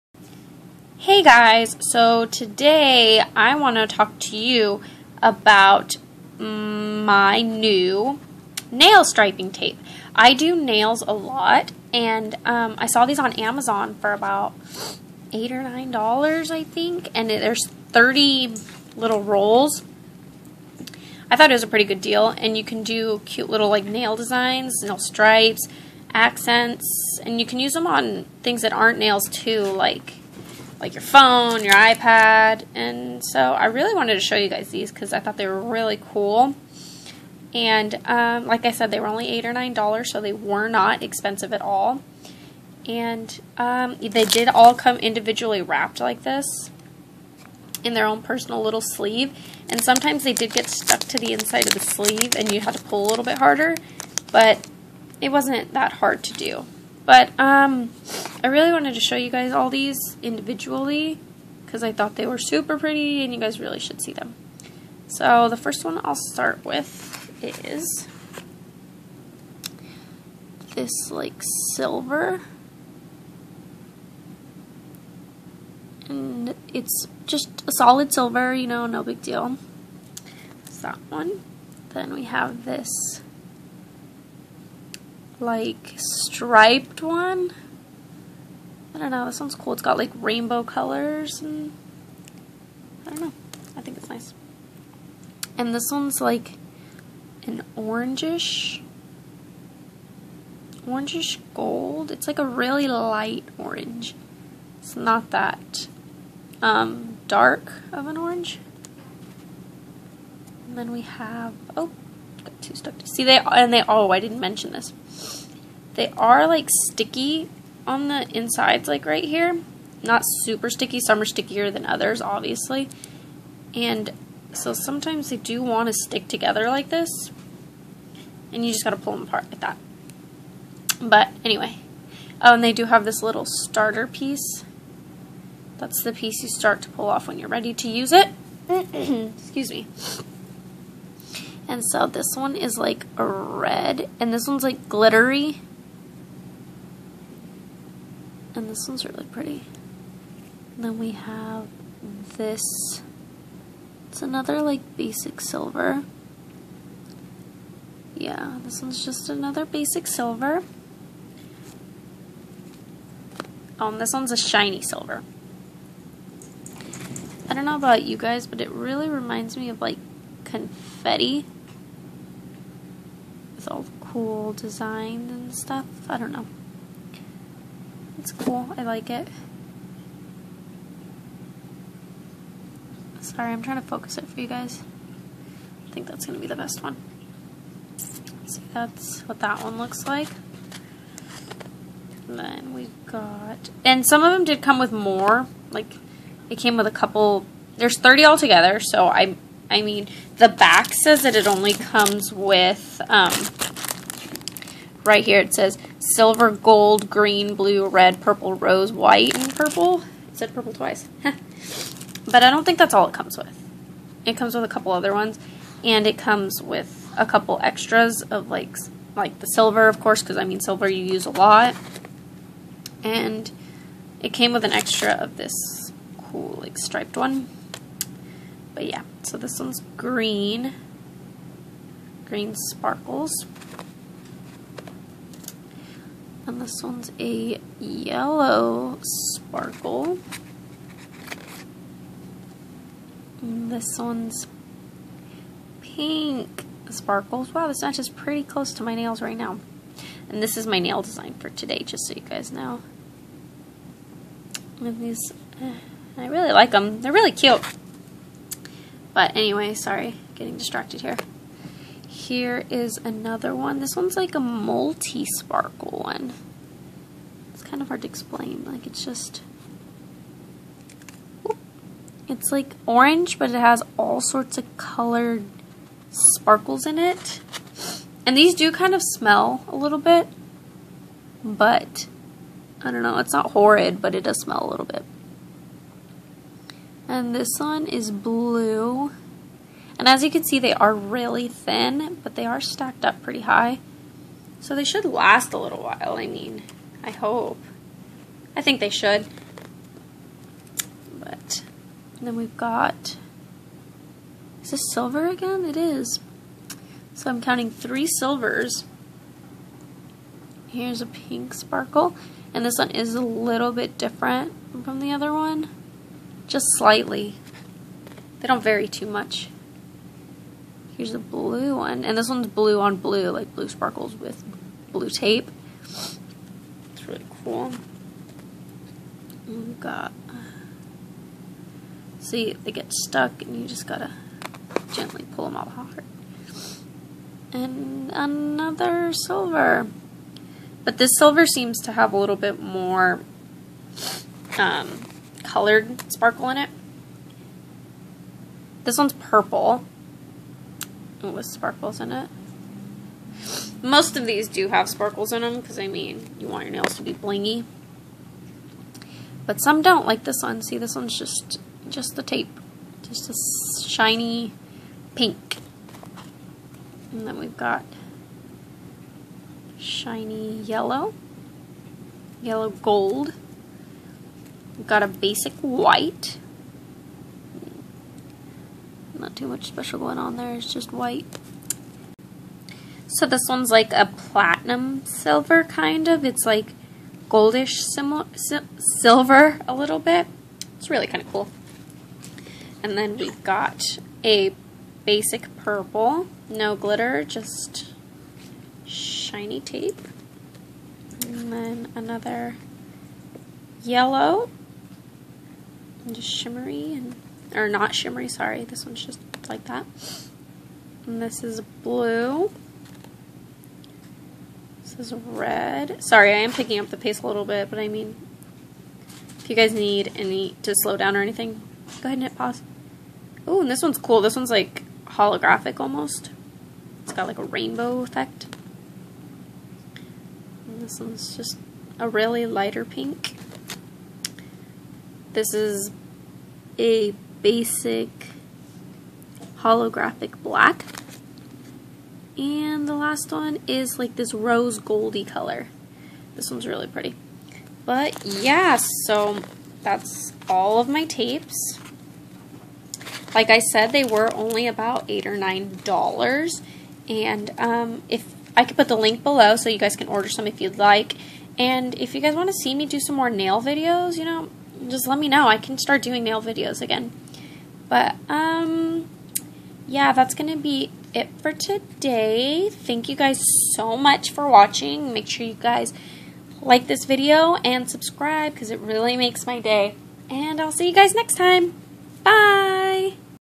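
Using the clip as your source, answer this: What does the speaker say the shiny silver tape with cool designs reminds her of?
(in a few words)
confetti.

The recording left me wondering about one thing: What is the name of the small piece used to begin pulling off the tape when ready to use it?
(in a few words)
starter piece.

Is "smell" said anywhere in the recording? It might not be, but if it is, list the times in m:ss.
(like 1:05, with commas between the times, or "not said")
4:39, 4:44.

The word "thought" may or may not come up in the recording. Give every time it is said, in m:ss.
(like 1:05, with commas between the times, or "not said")
0:21, 0:35, 1:01.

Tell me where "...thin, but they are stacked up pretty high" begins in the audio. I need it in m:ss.
4:51.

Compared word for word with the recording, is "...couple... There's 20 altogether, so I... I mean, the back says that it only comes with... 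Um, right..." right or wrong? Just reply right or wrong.
wrong.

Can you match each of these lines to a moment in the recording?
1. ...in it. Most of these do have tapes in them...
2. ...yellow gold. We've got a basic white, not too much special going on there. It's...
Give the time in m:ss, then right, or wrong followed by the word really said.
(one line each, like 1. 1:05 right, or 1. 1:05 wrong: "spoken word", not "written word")
1. 5:51 wrong: "sparkles", not "tapes"
2. 6:12 right.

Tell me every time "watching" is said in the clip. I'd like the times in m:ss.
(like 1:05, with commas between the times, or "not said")
7:54.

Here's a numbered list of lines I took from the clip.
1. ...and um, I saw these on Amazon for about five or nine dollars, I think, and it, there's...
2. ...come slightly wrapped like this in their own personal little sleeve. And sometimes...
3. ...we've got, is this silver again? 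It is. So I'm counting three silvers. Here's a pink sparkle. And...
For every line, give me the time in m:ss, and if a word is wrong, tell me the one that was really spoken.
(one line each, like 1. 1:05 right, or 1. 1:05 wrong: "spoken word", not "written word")
1. 0:11 wrong: "eight", not "five"
2. 0:44 wrong: "individually", not "slightly"
3. 5:02 right.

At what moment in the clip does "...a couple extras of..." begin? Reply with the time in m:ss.
3:37.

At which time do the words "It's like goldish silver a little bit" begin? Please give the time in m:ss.
6:26.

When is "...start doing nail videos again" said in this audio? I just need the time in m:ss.
7:45.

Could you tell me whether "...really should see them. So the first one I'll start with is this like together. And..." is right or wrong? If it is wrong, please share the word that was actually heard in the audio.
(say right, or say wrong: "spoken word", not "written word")
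wrong: "silver", not "together".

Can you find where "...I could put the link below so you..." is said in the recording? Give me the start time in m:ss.
7:38.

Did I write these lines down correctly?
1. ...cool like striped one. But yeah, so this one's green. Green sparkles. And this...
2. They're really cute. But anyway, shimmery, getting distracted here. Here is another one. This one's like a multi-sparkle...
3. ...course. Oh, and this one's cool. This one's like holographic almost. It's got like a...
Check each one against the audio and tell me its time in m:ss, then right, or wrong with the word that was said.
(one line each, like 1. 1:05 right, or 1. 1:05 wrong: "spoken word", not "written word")
1. 3:46 right
2. 4:17 wrong: "sorry", not "shimmery"
3. 7:02 wrong: "pause", not "course".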